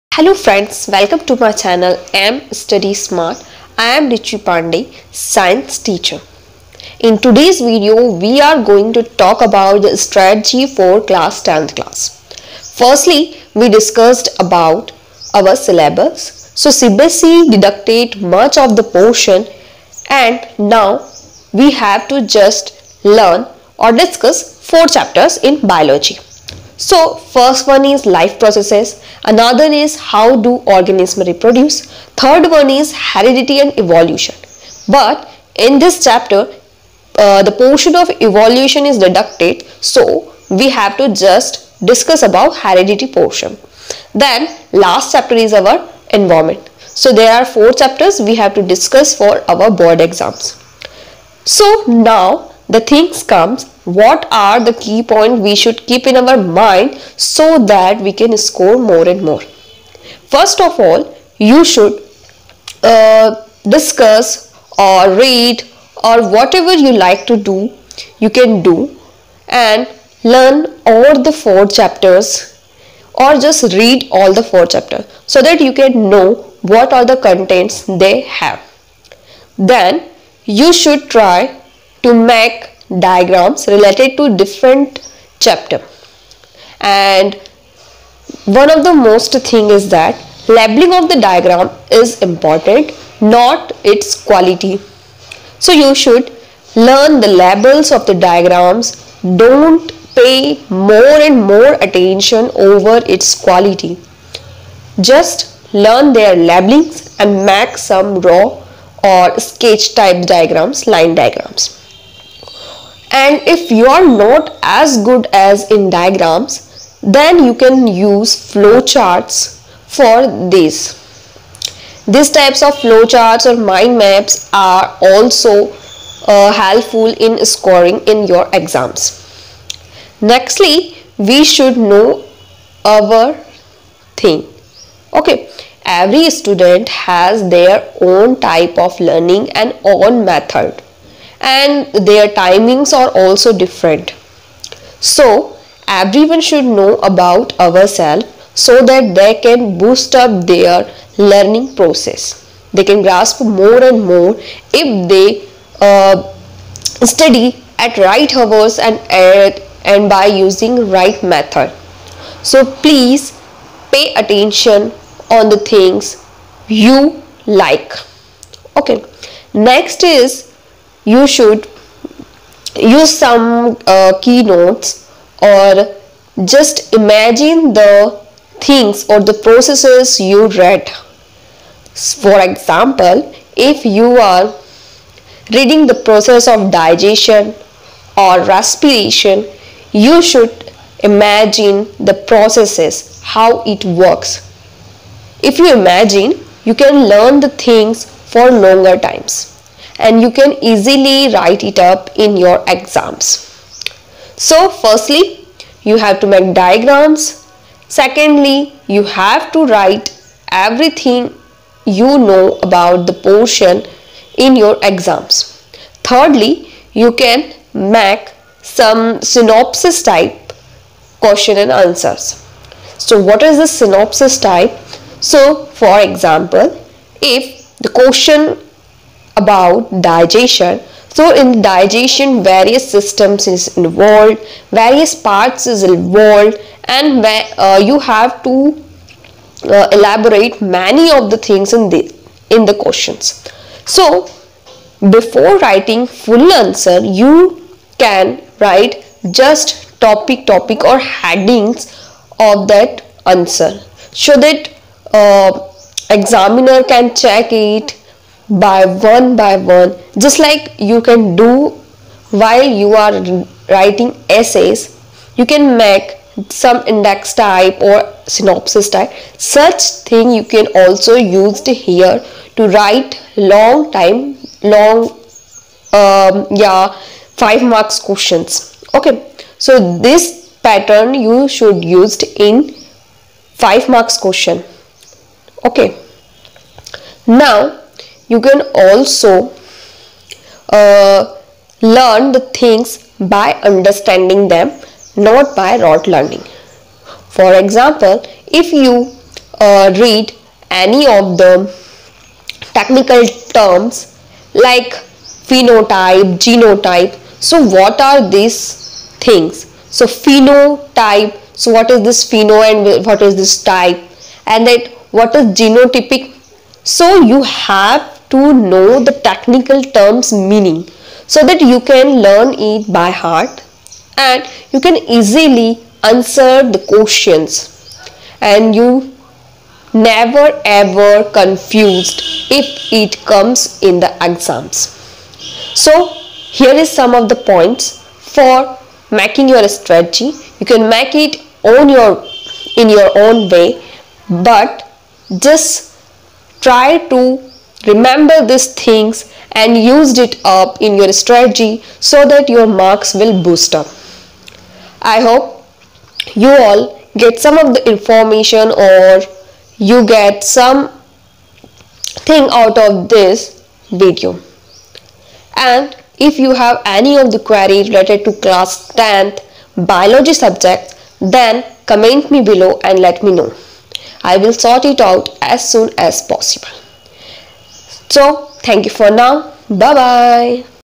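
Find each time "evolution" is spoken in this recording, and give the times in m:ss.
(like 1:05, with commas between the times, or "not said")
0:33, 0:38.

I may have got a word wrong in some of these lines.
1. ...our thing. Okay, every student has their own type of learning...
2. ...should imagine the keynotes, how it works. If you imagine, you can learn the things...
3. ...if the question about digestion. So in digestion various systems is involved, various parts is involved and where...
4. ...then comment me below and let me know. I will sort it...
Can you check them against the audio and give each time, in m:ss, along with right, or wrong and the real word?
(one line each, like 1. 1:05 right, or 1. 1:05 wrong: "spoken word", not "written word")
1. 2:12 right
2. 3:10 wrong: "processes", not "keynotes"
3. 3:47 right
4. 6:11 right.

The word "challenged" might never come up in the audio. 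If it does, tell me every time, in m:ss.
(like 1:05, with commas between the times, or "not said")
not said.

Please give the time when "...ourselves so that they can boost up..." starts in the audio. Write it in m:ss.
2:27.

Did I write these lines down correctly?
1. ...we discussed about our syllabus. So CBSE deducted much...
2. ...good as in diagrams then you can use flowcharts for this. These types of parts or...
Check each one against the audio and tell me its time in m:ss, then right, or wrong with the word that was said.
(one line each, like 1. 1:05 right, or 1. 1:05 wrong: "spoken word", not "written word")
1. 0:13 right
2. 1:55 wrong: "flowcharts", not "parts".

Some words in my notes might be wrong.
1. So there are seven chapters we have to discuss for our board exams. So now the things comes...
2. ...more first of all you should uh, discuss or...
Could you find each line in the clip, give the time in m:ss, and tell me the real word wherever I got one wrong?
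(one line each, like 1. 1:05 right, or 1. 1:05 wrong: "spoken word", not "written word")
1. 0:46 wrong: "four", not "seven"
2. 0:59 right.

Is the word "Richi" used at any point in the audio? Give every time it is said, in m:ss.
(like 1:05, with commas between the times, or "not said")
0:04.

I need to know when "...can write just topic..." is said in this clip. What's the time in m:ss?
4:07.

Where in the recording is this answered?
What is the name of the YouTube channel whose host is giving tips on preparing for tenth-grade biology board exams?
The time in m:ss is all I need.
0:02.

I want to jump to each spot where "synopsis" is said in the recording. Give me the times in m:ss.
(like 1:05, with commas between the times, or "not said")
3:39, 3:43, 4:28.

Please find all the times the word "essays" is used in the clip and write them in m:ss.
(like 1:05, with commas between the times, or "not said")
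4:24.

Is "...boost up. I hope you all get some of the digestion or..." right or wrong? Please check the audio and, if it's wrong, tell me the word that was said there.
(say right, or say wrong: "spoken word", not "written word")
wrong: "information", not "digestion".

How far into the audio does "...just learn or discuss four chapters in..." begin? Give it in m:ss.
0:22.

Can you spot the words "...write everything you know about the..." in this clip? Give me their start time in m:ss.
3:29.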